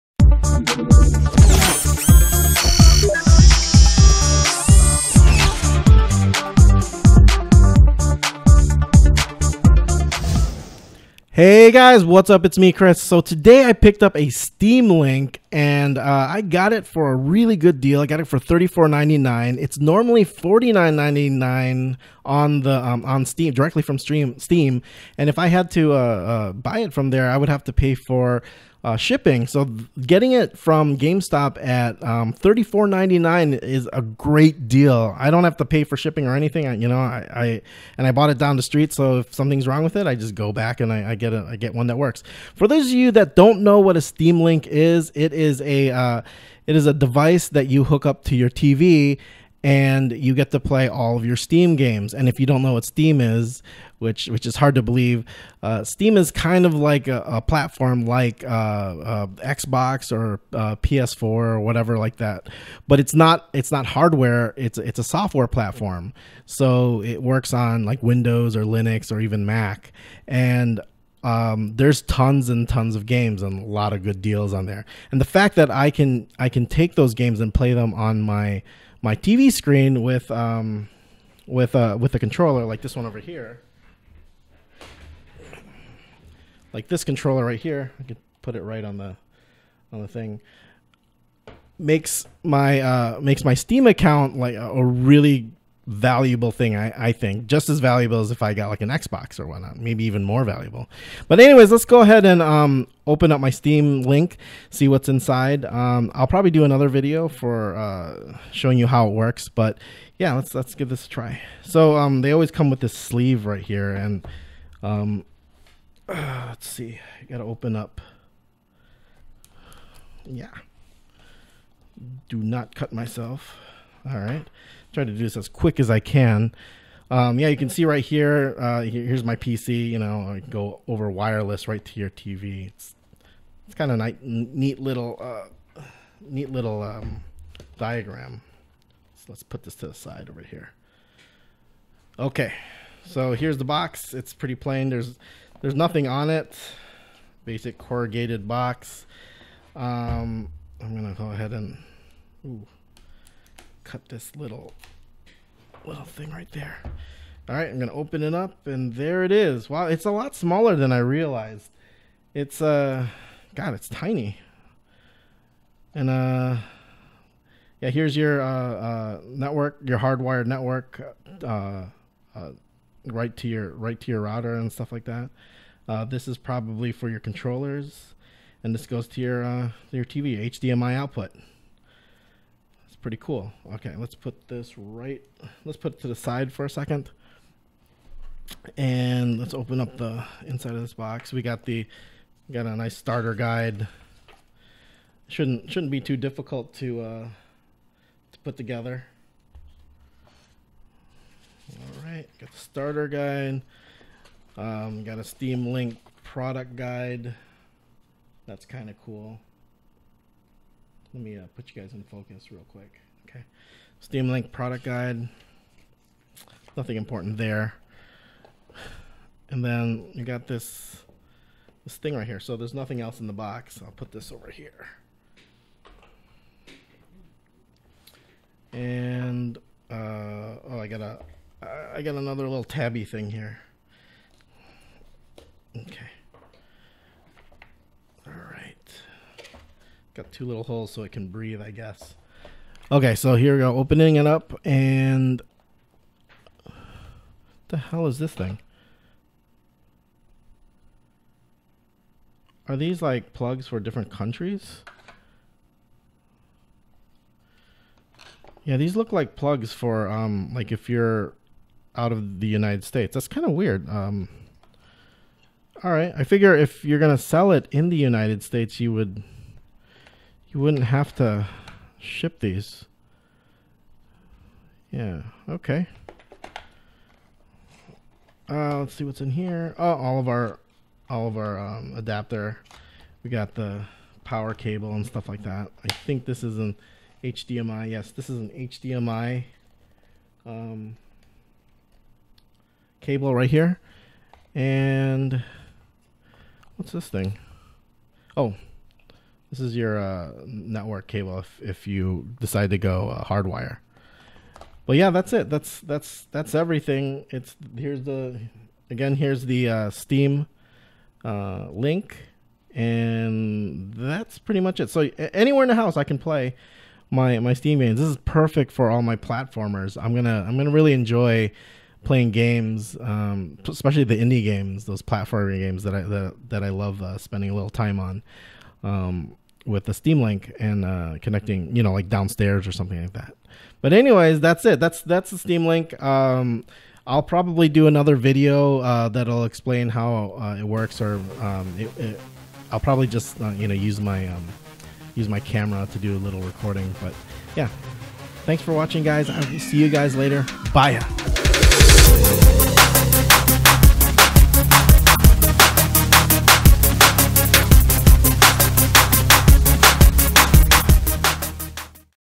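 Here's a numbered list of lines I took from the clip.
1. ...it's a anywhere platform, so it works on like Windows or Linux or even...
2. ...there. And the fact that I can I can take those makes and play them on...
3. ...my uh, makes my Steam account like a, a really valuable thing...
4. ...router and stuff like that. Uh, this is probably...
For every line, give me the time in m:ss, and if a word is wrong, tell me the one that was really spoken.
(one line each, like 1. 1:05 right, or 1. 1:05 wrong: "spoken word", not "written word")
1. 1:04 wrong: "software", not "anywhere"
2. 1:14 wrong: "games", not "makes"
3. 1:32 right
4. 2:54 right.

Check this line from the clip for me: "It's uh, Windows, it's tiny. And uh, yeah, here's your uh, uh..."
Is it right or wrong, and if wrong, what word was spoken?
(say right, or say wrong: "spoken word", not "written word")
wrong: "God", not "Windows".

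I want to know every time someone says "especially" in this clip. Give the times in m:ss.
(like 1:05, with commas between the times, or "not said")
5:23.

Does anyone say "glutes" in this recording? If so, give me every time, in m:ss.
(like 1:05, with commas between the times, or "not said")
not said.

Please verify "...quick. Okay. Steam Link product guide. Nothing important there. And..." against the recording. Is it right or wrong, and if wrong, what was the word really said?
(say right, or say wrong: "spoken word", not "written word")
right.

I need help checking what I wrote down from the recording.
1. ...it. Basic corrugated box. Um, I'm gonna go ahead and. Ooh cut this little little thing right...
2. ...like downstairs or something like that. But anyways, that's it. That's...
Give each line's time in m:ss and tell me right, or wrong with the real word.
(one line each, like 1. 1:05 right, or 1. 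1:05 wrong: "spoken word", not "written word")
1. 2:26 right
2. 5:31 right.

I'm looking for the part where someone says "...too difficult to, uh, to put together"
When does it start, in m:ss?
3:16.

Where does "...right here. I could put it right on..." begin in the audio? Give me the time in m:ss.
1:27.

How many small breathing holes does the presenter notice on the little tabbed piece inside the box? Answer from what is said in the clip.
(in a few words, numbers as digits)
2.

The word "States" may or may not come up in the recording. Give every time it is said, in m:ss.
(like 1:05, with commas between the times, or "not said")
4:22, 4:28.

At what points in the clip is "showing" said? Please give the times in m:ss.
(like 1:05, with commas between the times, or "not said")
1:48.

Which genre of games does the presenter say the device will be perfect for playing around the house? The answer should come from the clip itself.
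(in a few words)
Platformers.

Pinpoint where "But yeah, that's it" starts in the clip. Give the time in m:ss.
5:04.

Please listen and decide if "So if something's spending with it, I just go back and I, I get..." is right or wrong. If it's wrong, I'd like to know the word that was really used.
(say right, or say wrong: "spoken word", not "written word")
wrong: "wrong", not "spending".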